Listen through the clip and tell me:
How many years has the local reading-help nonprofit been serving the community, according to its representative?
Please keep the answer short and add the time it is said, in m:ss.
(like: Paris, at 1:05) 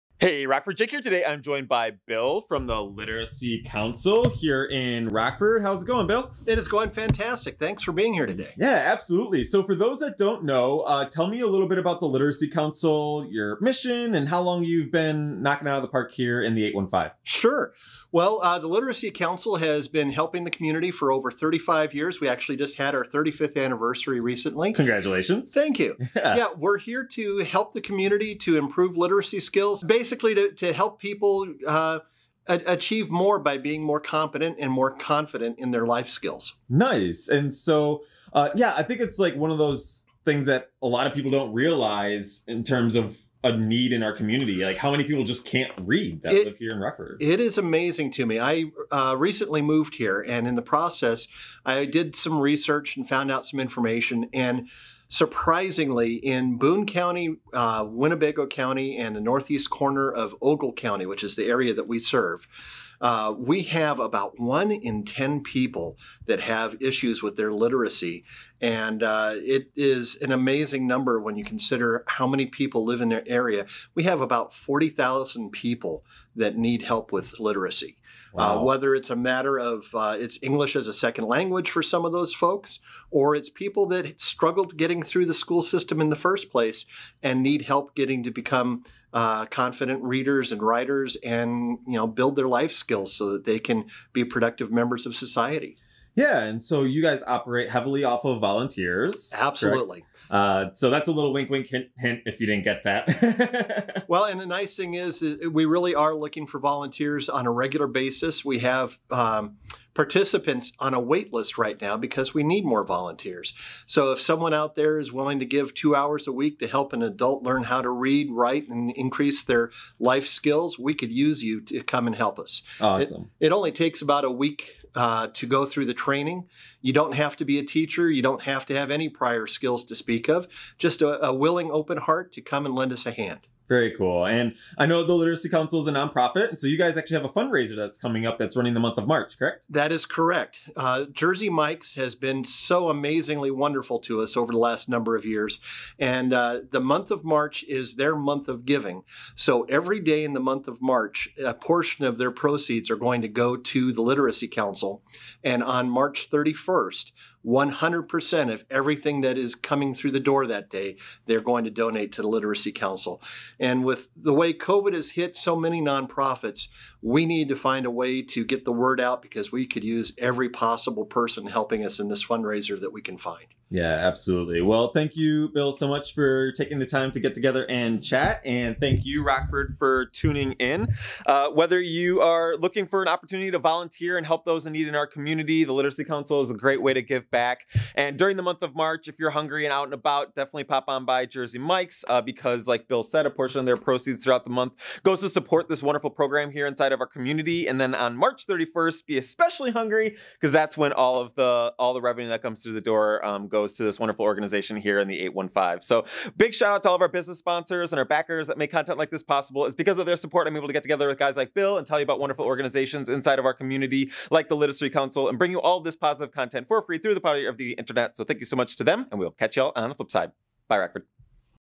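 35, at 0:21.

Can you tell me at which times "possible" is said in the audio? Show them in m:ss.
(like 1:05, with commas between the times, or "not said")
2:50, 3:29.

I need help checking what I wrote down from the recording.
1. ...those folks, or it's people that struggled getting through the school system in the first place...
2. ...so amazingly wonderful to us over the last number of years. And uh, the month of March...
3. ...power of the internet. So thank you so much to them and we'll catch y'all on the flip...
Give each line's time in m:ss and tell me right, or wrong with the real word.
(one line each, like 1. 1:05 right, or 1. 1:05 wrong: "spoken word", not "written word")
1. 1:22 right
2. 2:22 right
3. 3:37 right.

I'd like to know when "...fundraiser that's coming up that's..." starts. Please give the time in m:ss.
2:17.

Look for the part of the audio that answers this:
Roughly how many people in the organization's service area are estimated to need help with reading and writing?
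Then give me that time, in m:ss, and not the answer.
1:14.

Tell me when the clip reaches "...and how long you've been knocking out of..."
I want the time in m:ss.
0:14.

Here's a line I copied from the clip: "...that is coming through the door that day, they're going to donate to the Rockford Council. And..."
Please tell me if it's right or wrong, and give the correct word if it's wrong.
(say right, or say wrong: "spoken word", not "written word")
wrong: "Literacy", not "Rockford".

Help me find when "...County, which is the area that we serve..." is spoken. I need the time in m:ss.
1:00.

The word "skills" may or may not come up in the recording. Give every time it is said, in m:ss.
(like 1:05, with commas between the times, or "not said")
0:29, 0:36, 1:32, 2:00, 2:09.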